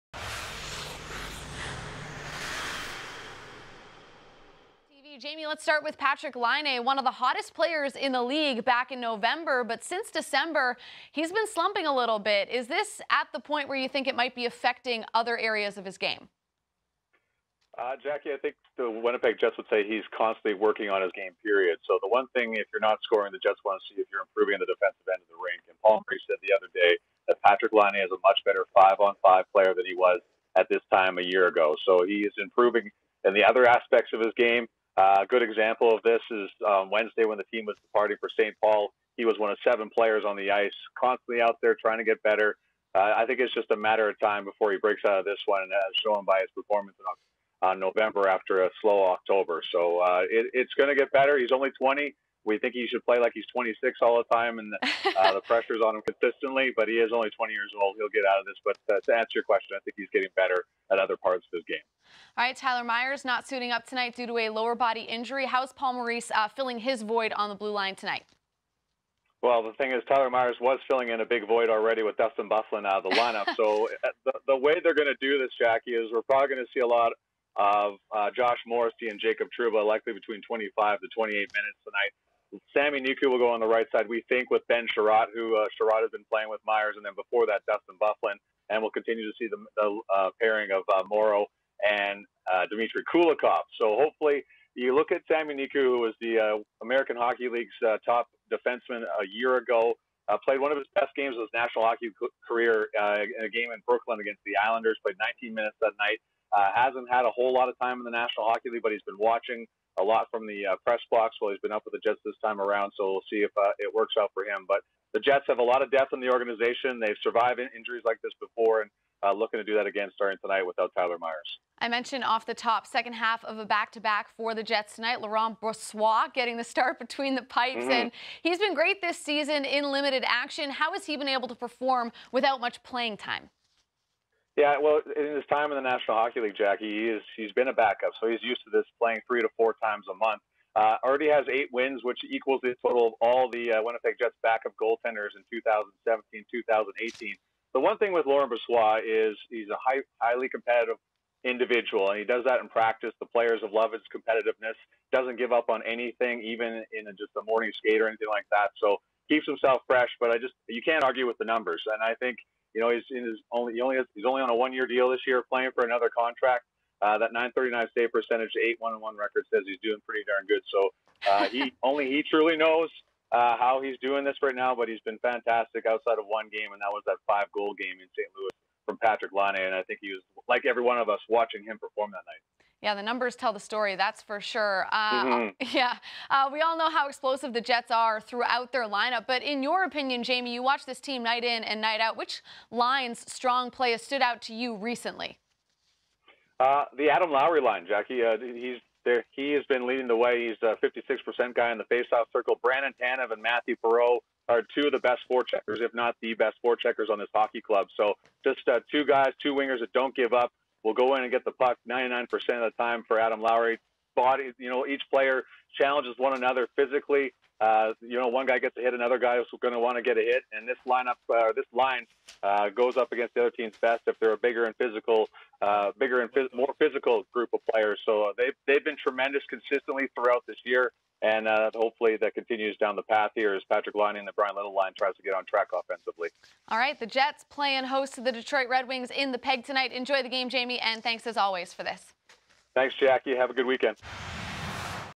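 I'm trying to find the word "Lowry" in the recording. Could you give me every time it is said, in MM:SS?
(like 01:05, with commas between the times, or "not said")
03:17, 03:33.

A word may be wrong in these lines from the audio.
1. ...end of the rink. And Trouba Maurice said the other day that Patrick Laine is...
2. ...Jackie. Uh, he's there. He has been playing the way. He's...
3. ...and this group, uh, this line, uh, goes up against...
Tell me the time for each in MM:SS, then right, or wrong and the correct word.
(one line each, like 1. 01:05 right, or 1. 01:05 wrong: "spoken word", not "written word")
1. 00:25 wrong: "Paul", not "Trouba"
2. 03:17 wrong: "leading", not "playing"
3. 03:40 wrong: "lineup", not "group".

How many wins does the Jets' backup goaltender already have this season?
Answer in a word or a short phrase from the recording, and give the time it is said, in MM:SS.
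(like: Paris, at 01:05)
8, at 02:21.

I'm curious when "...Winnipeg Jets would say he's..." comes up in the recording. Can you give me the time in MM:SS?
00:18.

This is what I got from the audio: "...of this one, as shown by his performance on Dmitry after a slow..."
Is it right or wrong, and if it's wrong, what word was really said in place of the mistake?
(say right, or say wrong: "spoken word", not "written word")
wrong: "November", not "Dmitry".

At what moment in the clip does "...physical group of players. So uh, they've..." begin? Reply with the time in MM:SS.
03:46.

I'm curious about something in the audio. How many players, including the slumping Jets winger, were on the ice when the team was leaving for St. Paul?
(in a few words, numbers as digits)
7.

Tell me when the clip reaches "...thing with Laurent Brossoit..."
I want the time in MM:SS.
02:27.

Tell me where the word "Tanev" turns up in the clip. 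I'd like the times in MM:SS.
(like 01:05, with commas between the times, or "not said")
03:23.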